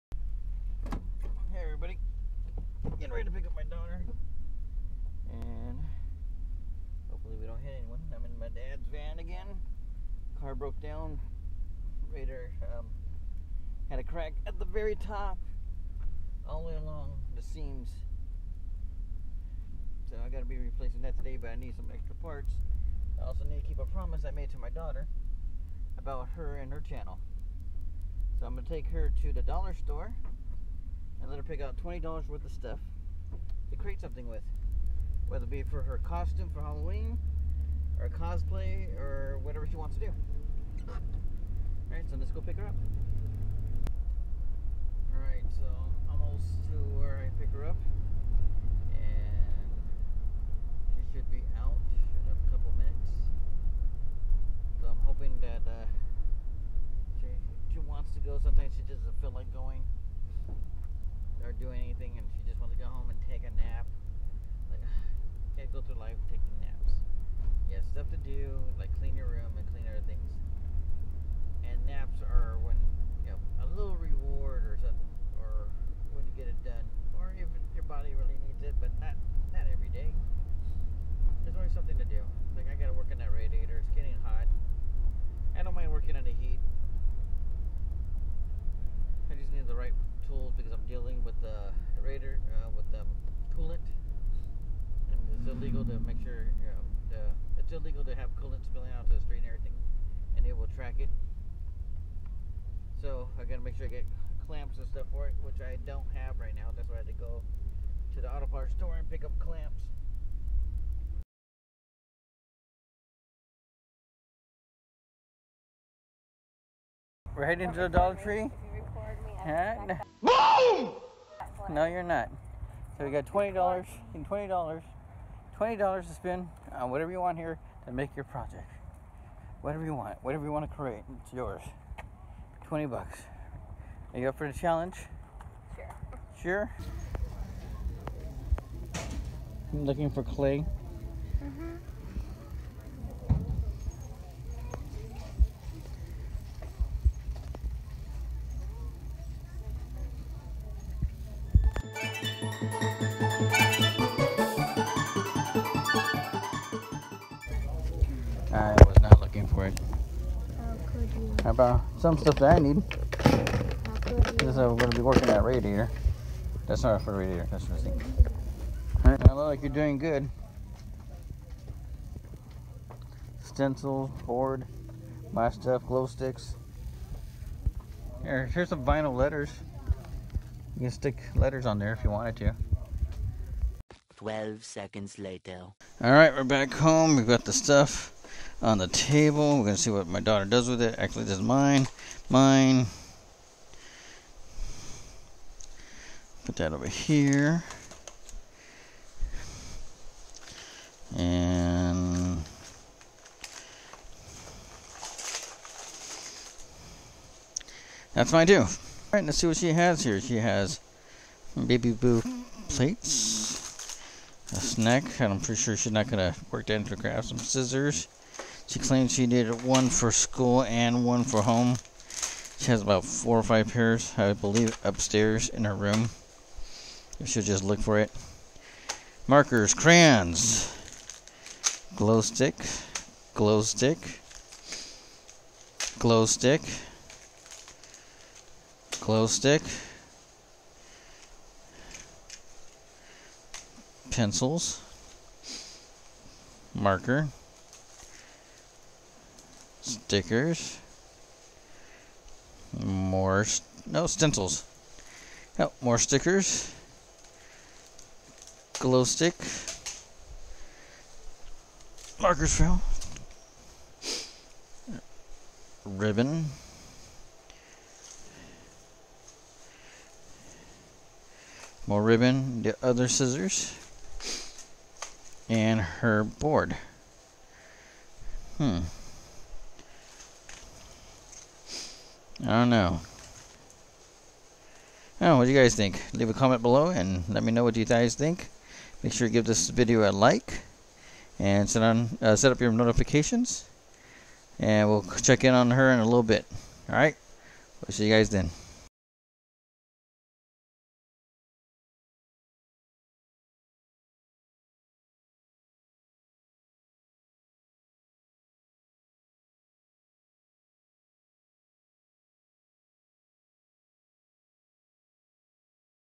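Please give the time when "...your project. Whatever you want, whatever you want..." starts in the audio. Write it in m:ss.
2:08.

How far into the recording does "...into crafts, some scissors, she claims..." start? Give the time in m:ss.
3:36.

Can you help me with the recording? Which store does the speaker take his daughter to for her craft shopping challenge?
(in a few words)
Dollar Tree.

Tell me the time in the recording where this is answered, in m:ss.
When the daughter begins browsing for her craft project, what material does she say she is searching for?
2:20.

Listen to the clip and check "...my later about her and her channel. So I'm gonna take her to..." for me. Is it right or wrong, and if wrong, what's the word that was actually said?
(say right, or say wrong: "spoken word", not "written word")
wrong: "daughter", not "later".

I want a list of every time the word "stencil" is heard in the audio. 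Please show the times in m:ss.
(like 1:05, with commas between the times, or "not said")
2:53, 4:14.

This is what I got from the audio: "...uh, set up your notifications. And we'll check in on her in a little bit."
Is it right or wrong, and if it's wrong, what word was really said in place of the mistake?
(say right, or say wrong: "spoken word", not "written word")
right.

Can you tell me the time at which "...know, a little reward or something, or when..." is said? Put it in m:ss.
1:13.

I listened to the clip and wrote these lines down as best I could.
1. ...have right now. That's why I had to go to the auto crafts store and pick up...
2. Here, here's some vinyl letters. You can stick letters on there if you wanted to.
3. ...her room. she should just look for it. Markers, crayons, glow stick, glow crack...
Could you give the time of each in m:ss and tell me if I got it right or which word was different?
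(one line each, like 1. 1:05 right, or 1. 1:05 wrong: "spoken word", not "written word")
1. 1:46 wrong: "parts", not "crafts"
2. 2:58 right
3. 3:45 wrong: "stick", not "crack".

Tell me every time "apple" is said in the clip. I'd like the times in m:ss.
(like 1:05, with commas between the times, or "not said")
not said.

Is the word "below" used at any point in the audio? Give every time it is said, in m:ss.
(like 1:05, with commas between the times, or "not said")
4:46.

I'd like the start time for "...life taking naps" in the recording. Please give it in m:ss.
1:05.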